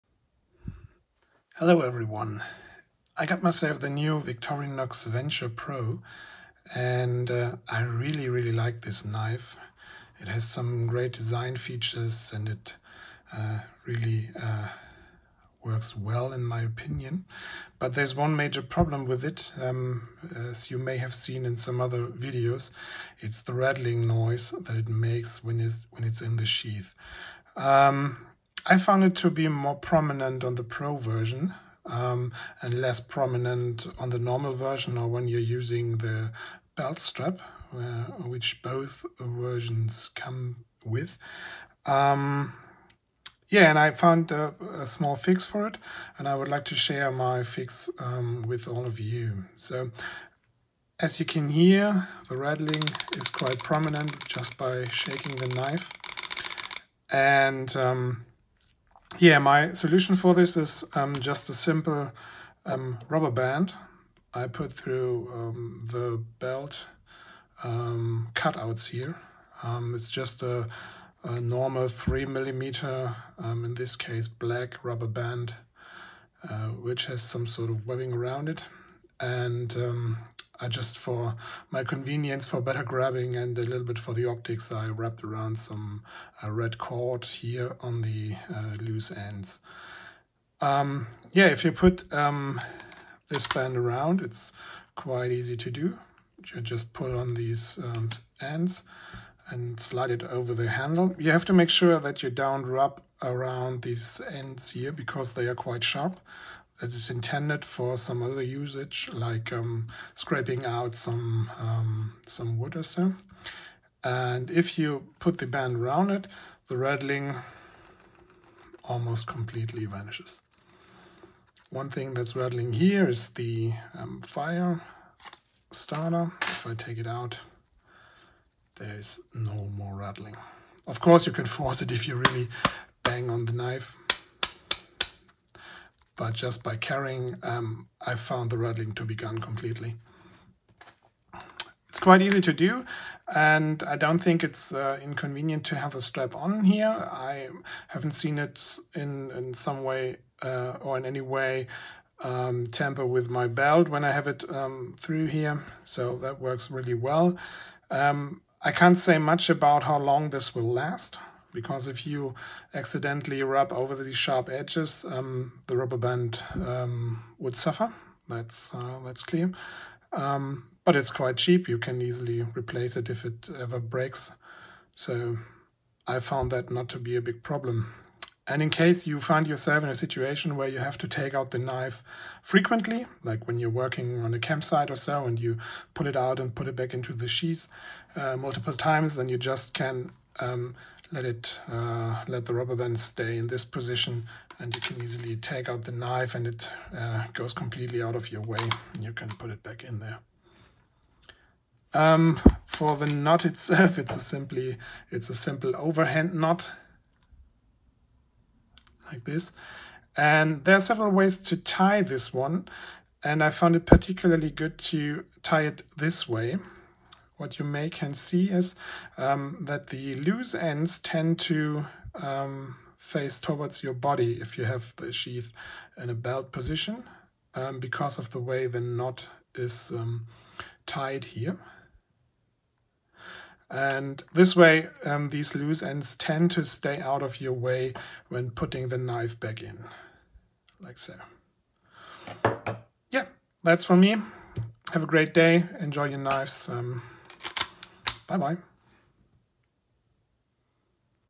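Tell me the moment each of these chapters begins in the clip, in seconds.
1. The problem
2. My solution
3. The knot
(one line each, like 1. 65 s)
1. 17 s
2. 58 s
3. 201 s.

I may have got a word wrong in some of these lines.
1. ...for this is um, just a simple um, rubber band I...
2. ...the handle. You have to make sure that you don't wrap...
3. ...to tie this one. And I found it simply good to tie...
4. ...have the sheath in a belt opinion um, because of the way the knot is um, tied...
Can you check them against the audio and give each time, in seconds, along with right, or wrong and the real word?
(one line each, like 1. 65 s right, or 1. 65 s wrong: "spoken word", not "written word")
1. 60 s right
2. 100 s right
3. 211 s wrong: "particularly", not "simply"
4. 224 s wrong: "position", not "opinion".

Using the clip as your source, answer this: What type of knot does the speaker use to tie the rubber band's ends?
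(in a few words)
overhand knot.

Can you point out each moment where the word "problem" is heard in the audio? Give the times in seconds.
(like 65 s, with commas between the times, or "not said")
18 s, 177 s.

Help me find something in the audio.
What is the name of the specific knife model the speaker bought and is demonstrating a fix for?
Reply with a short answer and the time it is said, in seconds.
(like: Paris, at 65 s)
Victorinox Venture Pro, at 4 s.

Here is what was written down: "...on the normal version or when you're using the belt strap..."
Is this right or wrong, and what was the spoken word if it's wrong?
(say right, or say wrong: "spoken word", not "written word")
right.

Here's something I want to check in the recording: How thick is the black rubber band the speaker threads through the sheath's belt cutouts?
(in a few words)
3 millimeters.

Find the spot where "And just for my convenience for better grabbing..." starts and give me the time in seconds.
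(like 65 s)
79 s.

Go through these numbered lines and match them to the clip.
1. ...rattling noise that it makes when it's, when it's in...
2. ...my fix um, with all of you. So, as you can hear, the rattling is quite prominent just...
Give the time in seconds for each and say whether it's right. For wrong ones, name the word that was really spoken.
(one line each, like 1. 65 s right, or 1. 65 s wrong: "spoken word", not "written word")
1. 23 s right
2. 47 s right.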